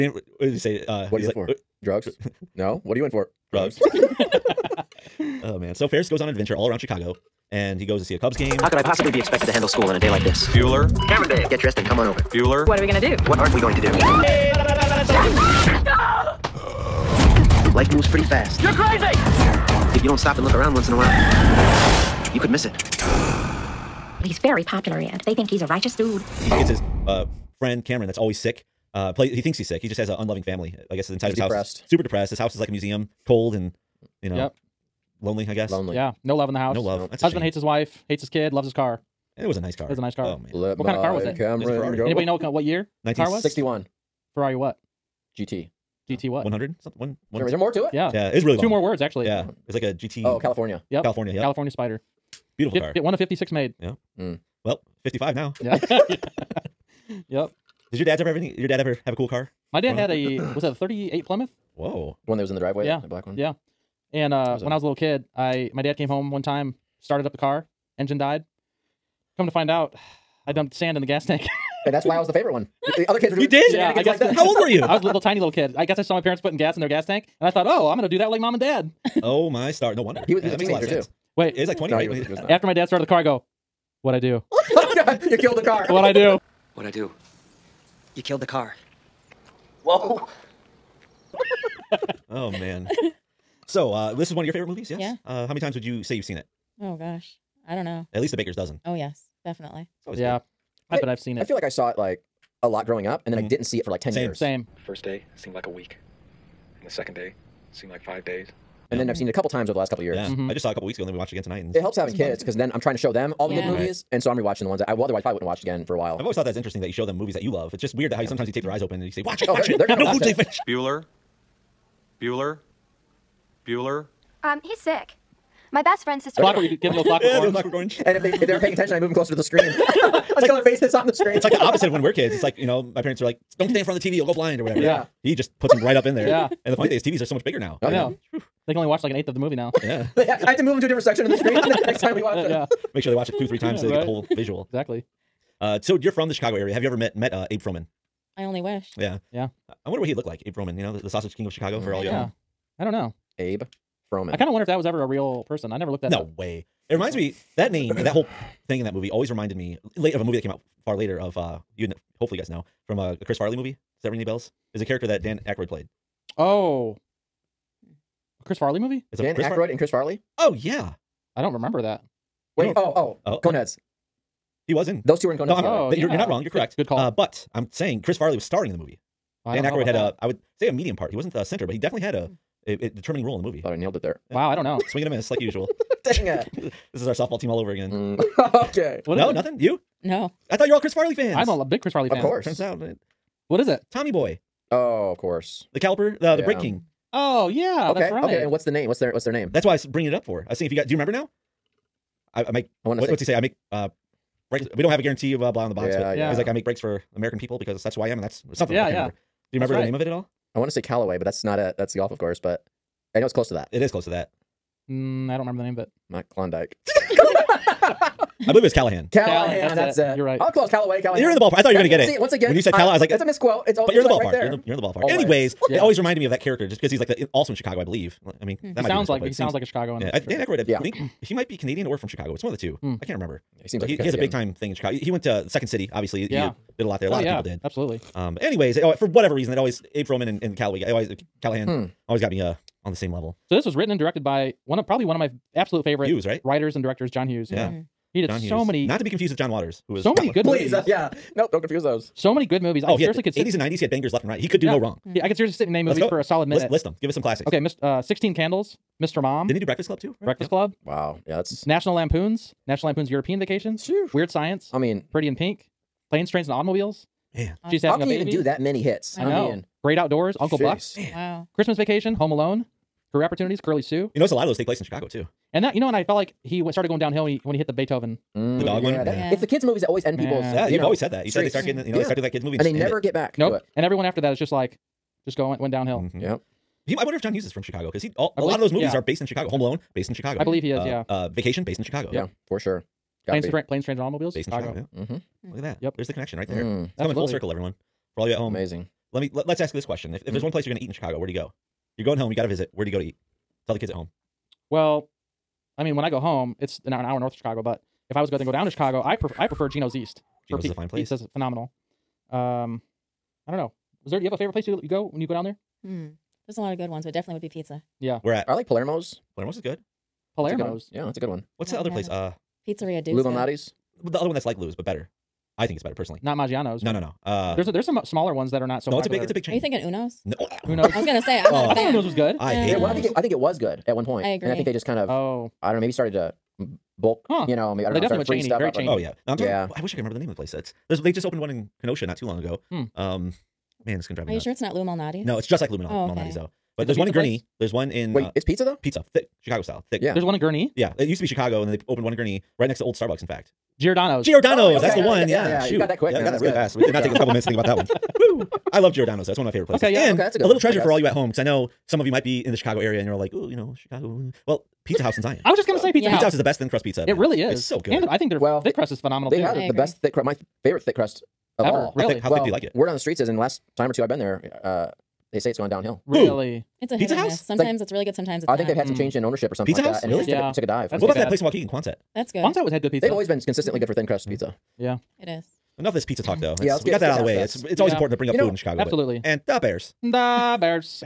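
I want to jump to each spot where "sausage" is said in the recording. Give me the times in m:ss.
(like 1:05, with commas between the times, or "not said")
2:31.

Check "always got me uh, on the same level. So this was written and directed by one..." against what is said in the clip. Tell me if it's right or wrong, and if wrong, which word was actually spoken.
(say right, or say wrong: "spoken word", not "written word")
right.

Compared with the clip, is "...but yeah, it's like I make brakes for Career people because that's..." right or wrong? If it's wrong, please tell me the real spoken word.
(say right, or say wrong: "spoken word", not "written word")
wrong: "American", not "Career".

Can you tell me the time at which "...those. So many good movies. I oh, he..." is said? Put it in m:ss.
4:11.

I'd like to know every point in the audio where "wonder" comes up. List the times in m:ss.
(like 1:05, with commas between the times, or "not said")
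1:20, 2:29, 2:34, 4:47.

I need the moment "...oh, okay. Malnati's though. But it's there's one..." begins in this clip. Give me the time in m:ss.
5:45.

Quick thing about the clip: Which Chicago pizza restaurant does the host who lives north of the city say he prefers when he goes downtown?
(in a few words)
Geno's East.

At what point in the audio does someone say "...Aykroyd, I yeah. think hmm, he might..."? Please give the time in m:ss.
3:50.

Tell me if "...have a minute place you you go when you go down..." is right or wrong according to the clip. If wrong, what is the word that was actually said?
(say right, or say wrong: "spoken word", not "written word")
wrong: "favorite", not "minute".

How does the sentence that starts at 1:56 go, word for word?
I've always thought that's interesting that you show them movies that you love.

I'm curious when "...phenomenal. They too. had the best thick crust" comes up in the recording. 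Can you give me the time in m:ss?
6:08.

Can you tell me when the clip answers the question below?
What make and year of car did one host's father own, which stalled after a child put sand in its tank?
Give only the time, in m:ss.
1:00.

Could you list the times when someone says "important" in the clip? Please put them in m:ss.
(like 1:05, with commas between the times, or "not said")
6:27.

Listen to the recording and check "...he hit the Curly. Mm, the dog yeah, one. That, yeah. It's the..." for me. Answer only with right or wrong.
wrong.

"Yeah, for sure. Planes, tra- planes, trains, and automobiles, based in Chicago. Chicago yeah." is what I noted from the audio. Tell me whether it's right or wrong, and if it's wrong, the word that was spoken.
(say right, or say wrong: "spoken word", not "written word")
right.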